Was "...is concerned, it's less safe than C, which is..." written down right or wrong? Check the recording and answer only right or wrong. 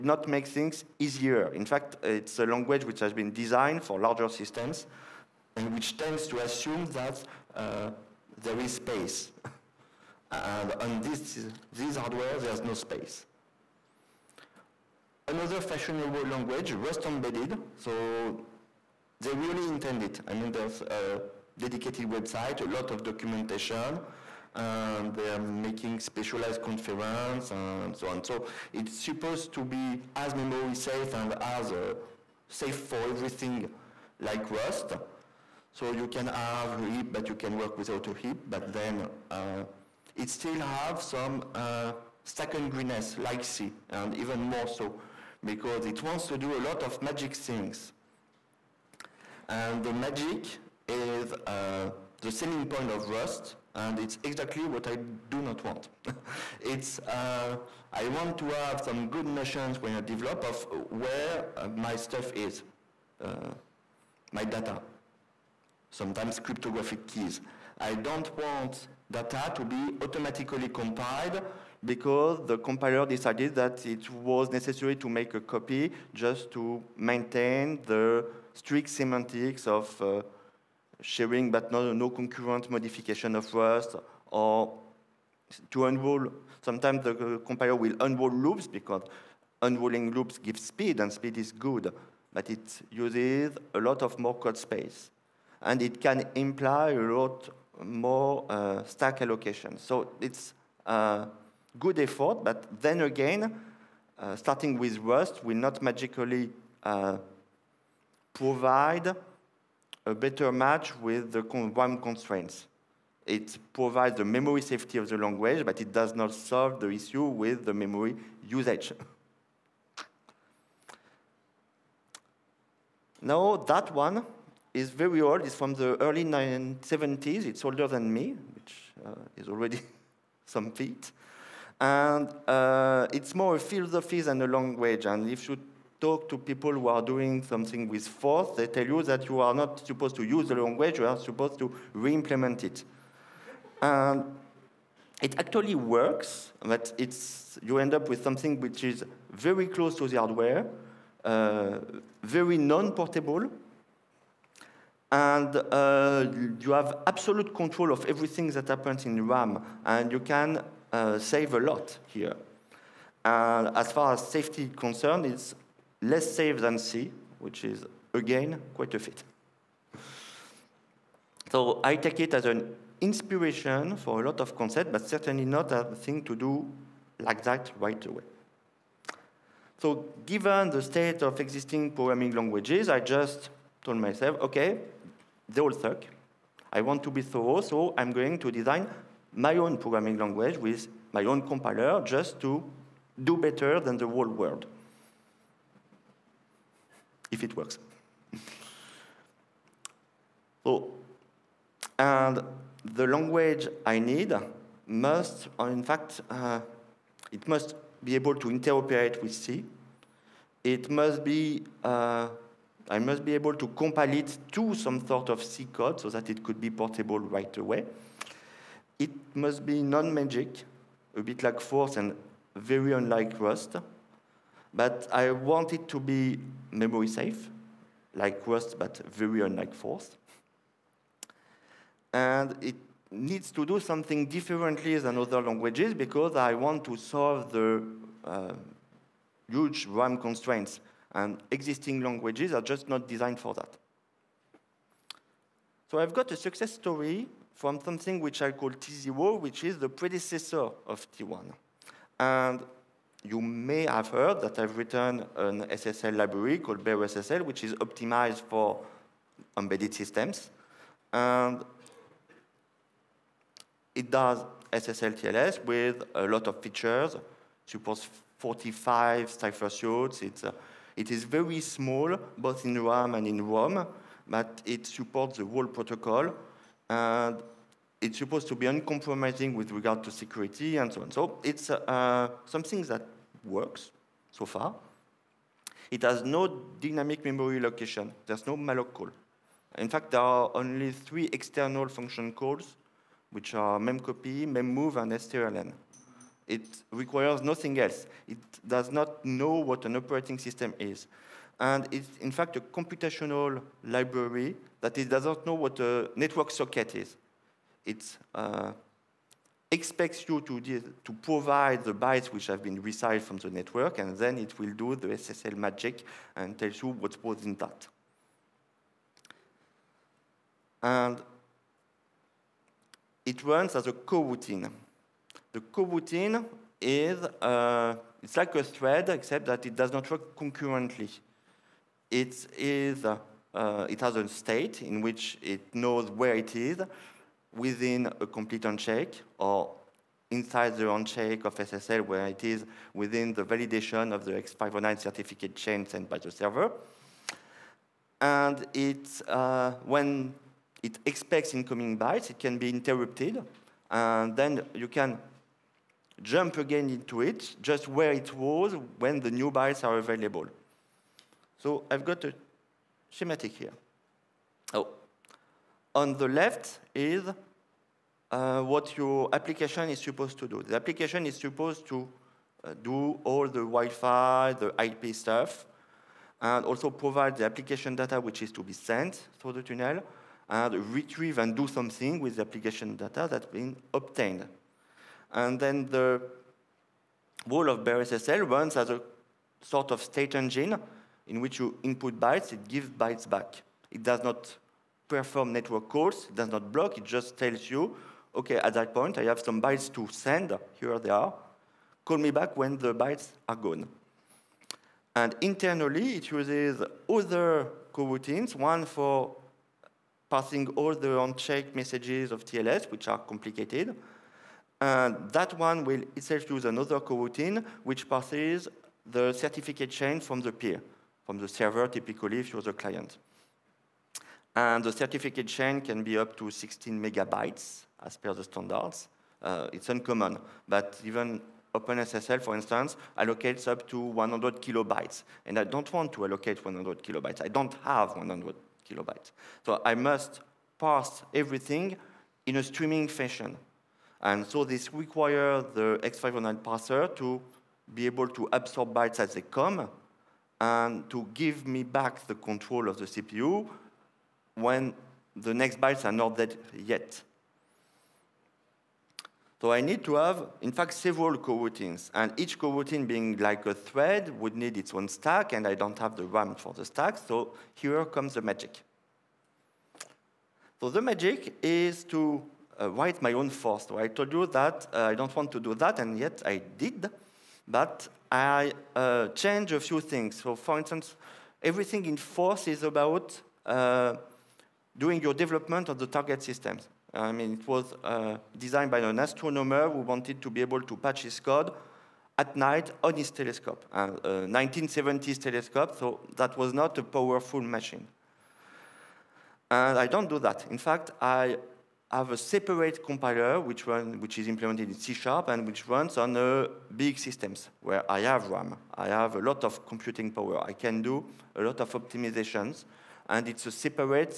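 right.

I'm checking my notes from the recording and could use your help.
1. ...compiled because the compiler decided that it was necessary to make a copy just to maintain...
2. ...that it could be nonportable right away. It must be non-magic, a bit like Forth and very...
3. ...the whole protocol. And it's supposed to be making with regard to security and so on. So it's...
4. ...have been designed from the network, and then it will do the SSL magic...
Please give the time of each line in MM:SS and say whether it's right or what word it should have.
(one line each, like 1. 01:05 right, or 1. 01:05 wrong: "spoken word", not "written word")
1. 01:10 right
2. 03:36 wrong: "portable", not "nonportable"
3. 04:35 wrong: "uncompromising", not "making"
4. 05:12 wrong: "resized", not "designed".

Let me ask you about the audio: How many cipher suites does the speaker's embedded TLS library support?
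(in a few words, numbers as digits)
45.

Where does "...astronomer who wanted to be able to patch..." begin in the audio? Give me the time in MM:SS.
08:09.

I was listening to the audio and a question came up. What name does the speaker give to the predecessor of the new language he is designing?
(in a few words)
T0.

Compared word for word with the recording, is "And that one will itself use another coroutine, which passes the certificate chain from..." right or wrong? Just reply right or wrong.
right.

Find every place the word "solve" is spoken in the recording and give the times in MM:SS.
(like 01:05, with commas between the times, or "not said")
01:56, 03:56.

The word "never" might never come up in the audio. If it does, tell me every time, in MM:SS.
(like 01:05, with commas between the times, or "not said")
not said.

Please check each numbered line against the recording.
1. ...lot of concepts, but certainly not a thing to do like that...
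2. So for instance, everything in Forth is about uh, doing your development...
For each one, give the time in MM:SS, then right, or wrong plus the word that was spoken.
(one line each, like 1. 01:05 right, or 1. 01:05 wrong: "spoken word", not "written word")
1. 02:54 right
2. 08:00 right.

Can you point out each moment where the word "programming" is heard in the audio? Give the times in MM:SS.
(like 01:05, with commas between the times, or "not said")
03:01, 03:09.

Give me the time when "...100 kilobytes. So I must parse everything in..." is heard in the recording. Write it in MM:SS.
07:18.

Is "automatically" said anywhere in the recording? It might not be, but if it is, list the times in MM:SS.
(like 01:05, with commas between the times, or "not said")
01:10.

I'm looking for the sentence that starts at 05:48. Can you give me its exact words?
And it, uh, when it expects incoming bytes, it can be interrupted.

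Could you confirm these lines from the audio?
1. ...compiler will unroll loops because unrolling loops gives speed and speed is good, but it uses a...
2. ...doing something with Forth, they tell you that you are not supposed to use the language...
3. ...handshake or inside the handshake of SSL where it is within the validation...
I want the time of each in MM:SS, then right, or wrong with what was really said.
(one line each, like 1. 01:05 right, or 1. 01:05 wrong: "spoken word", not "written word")
1. 01:27 right
2. 02:17 right
3. 05:38 right.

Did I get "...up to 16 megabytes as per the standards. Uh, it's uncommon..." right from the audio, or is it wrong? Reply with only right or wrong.
right.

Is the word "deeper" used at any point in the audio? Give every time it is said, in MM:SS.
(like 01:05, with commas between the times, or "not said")
not said.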